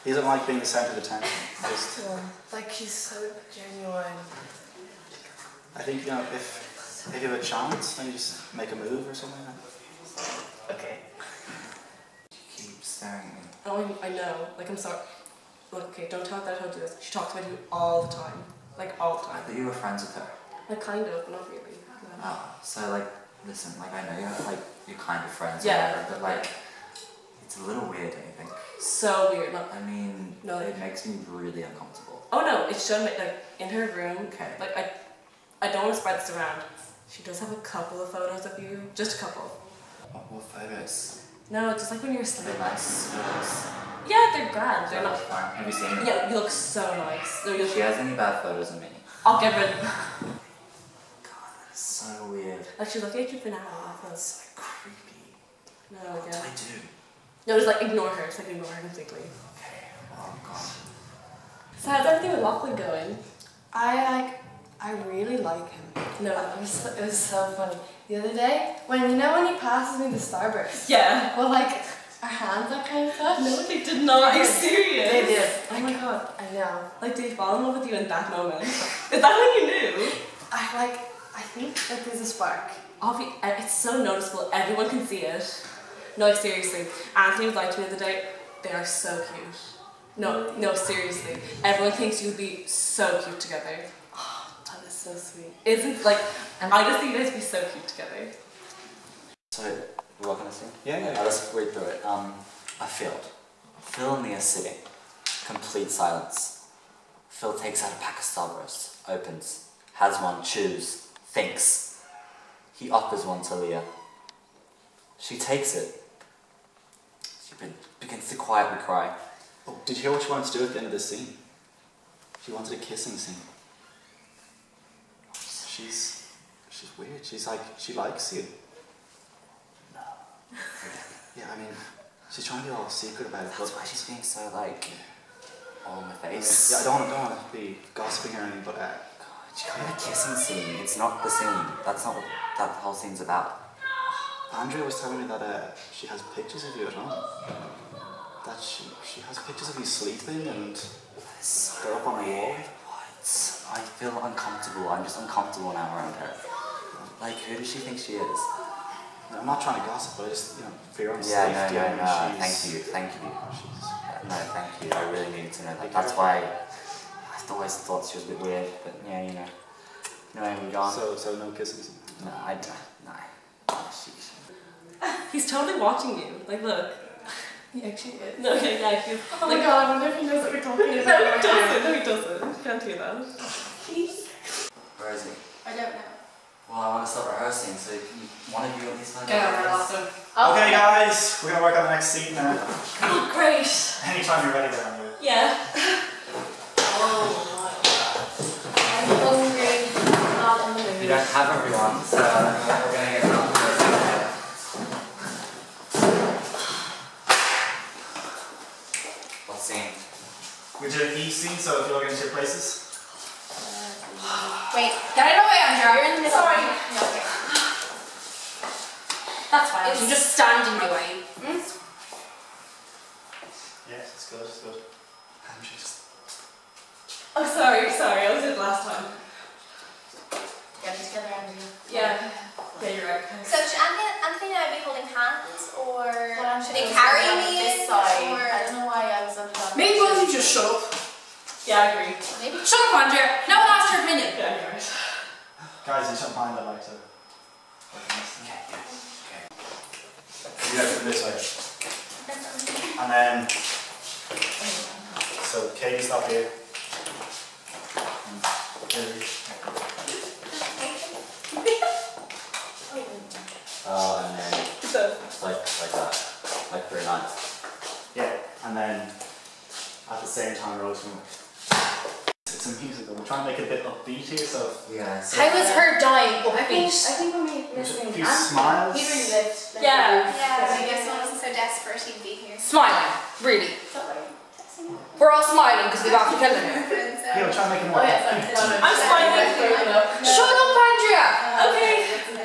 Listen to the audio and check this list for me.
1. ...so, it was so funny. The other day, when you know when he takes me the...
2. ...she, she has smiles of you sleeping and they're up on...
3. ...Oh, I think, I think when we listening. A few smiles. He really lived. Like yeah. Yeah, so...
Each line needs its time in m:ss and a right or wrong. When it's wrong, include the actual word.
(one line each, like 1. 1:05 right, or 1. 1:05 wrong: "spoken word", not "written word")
1. 1:06 wrong: "passes", not "takes"
2. 2:28 wrong: "pictures", not "smiles"
3. 4:36 right.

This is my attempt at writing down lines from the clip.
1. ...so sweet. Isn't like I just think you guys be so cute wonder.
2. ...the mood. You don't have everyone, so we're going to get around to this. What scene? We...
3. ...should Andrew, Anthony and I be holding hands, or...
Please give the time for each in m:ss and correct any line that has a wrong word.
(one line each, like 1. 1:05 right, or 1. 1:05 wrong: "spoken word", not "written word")
1. 1:34 wrong: "together", not "wonder"
2. 3:20 right
3. 3:53 wrong: "Anthony", not "Andrew".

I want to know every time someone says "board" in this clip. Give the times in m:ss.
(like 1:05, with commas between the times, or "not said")
not said.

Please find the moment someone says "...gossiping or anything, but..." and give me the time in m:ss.
2:17.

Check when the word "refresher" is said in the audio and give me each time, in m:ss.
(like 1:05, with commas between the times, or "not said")
not said.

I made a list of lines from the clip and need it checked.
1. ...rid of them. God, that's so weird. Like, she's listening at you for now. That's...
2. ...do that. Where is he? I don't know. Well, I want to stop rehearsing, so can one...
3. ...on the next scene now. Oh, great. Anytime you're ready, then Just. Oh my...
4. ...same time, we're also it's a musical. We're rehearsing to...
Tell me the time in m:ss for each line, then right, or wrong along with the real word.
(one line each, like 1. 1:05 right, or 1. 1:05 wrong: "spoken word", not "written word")
1. 0:49 wrong: "looking", not "listening"
2. 3:02 right
3. 3:11 wrong: "Yeah", not "Just"
4. 4:30 wrong: "trying", not "rehearsing".